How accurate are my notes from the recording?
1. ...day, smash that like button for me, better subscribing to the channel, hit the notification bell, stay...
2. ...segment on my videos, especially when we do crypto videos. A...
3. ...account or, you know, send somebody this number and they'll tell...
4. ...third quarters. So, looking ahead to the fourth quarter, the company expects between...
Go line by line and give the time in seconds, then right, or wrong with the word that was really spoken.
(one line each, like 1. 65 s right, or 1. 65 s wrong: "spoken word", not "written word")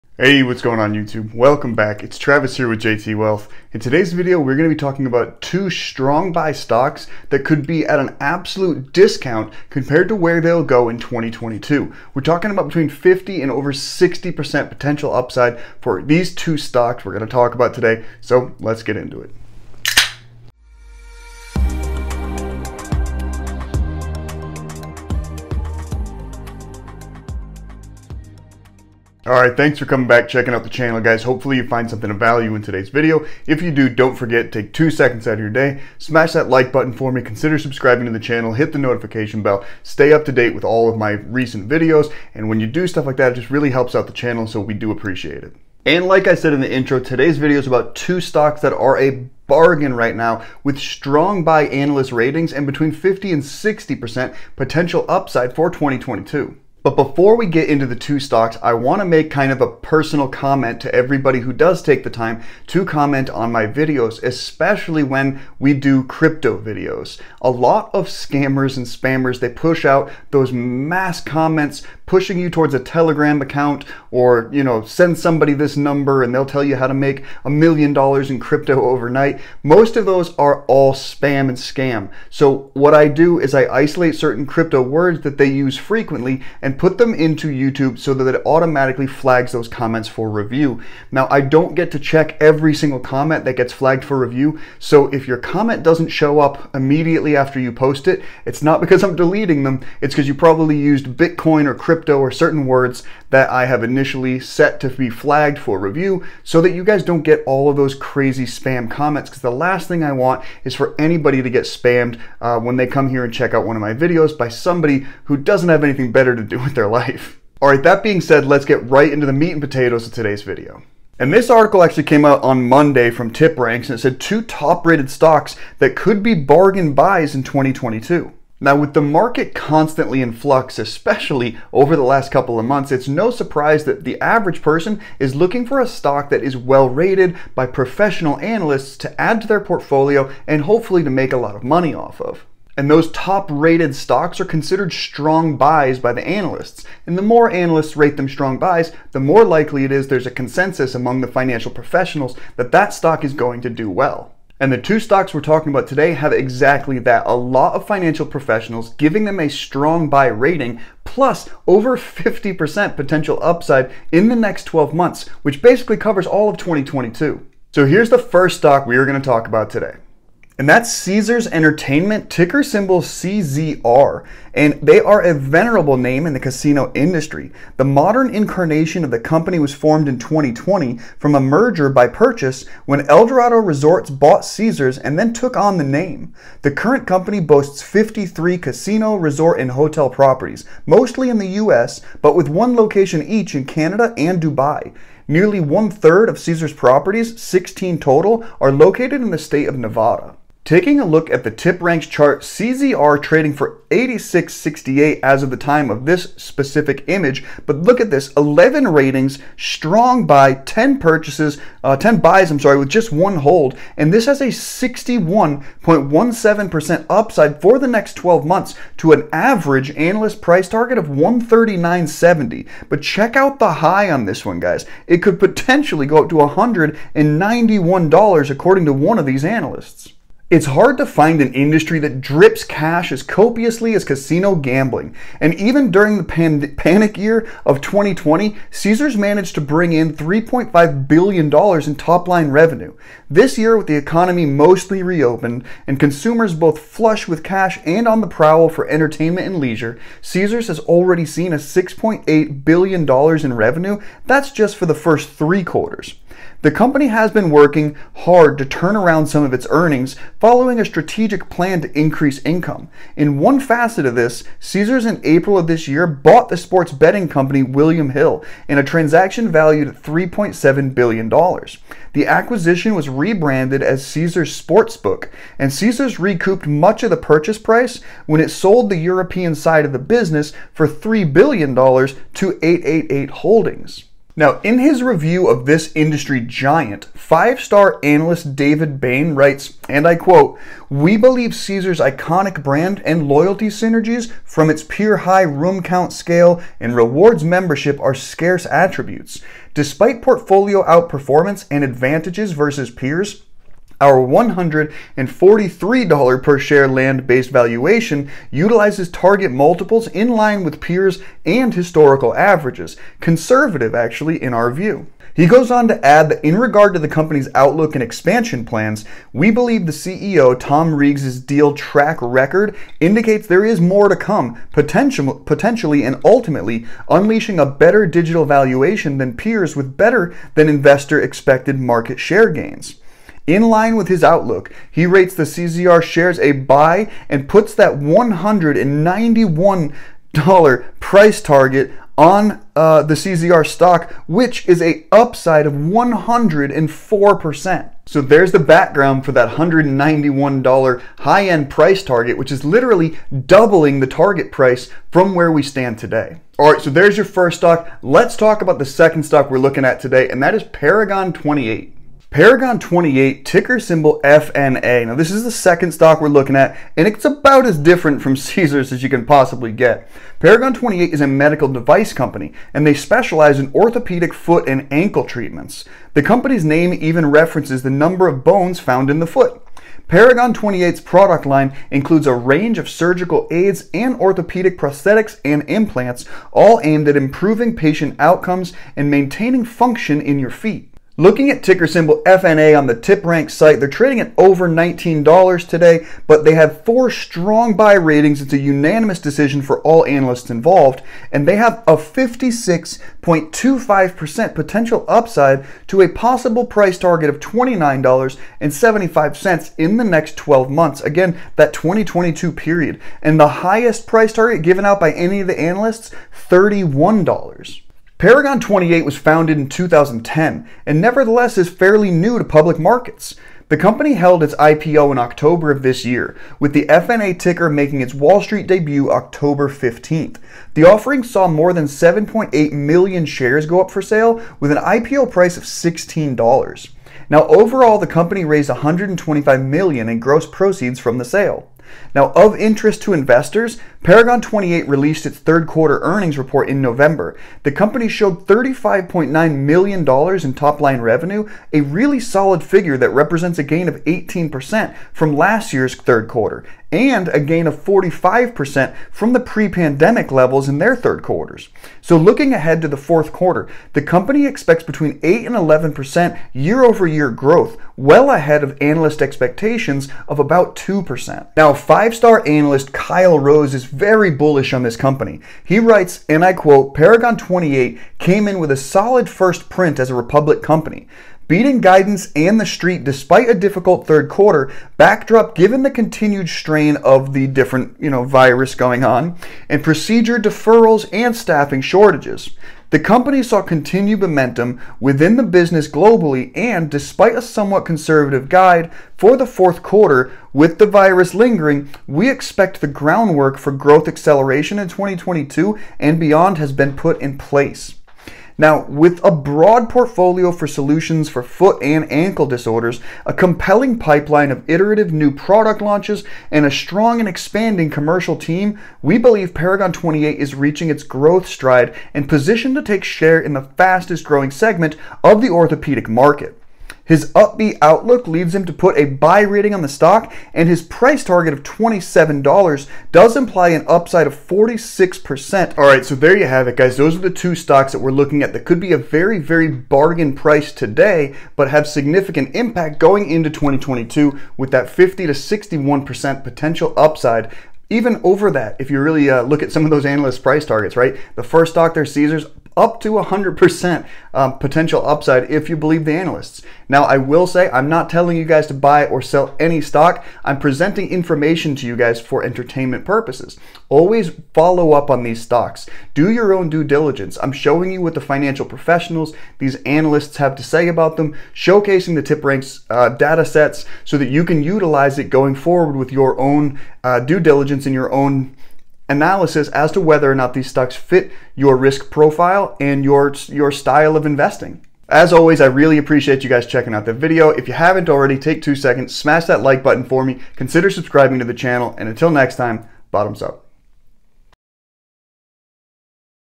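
1. 35 s wrong: "consider", not "better"
2. 62 s wrong: "comment", not "segment"
3. 73 s right
4. 460 s right.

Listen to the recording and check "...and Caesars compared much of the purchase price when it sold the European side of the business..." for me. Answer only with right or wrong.
wrong.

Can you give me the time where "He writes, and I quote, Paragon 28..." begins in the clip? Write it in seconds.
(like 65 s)
475 s.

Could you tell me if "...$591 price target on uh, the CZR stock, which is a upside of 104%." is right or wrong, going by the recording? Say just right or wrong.
wrong.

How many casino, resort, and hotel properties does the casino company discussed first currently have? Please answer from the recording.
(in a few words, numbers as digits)
53.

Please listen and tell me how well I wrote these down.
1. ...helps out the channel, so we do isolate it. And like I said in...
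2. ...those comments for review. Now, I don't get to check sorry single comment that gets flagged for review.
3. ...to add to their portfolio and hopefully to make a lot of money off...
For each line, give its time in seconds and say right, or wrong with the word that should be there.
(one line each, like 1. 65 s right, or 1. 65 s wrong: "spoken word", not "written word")
1. 43 s wrong: "appreciate", not "isolate"
2. 89 s wrong: "every", not "sorry"
3. 138 s right.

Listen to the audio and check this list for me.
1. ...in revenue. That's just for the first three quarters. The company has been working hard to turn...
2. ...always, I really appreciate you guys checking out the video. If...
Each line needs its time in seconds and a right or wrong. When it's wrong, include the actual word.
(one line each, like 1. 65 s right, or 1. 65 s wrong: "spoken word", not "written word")
1. 253 s right
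2. 585 s right.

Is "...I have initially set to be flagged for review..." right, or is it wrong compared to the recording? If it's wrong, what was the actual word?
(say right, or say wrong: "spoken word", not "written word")
right.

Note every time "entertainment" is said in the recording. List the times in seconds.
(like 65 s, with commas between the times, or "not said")
171 s, 248 s, 562 s.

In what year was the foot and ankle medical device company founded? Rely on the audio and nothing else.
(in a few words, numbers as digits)
2010.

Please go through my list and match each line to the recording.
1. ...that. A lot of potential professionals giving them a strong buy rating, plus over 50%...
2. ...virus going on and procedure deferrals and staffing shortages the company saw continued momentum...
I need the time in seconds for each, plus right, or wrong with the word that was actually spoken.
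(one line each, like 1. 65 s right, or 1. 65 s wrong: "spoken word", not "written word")
1. 156 s wrong: "financial", not "potential"
2. 488 s right.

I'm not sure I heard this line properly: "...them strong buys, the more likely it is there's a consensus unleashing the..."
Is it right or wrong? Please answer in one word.
wrong.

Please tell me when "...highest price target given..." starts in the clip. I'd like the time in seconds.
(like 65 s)
413 s.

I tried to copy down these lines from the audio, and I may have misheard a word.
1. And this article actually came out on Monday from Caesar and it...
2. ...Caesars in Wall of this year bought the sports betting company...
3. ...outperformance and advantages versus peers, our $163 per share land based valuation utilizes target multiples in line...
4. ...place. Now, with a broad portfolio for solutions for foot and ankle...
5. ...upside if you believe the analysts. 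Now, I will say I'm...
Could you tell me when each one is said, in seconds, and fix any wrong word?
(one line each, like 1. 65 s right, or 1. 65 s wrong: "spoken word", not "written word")
1. 121 s wrong: "TipRanks", not "Caesar"
2. 264 s wrong: "April", not "Wall"
3. 300 s wrong: "143", not "163"
4. 507 s right
5. 555 s right.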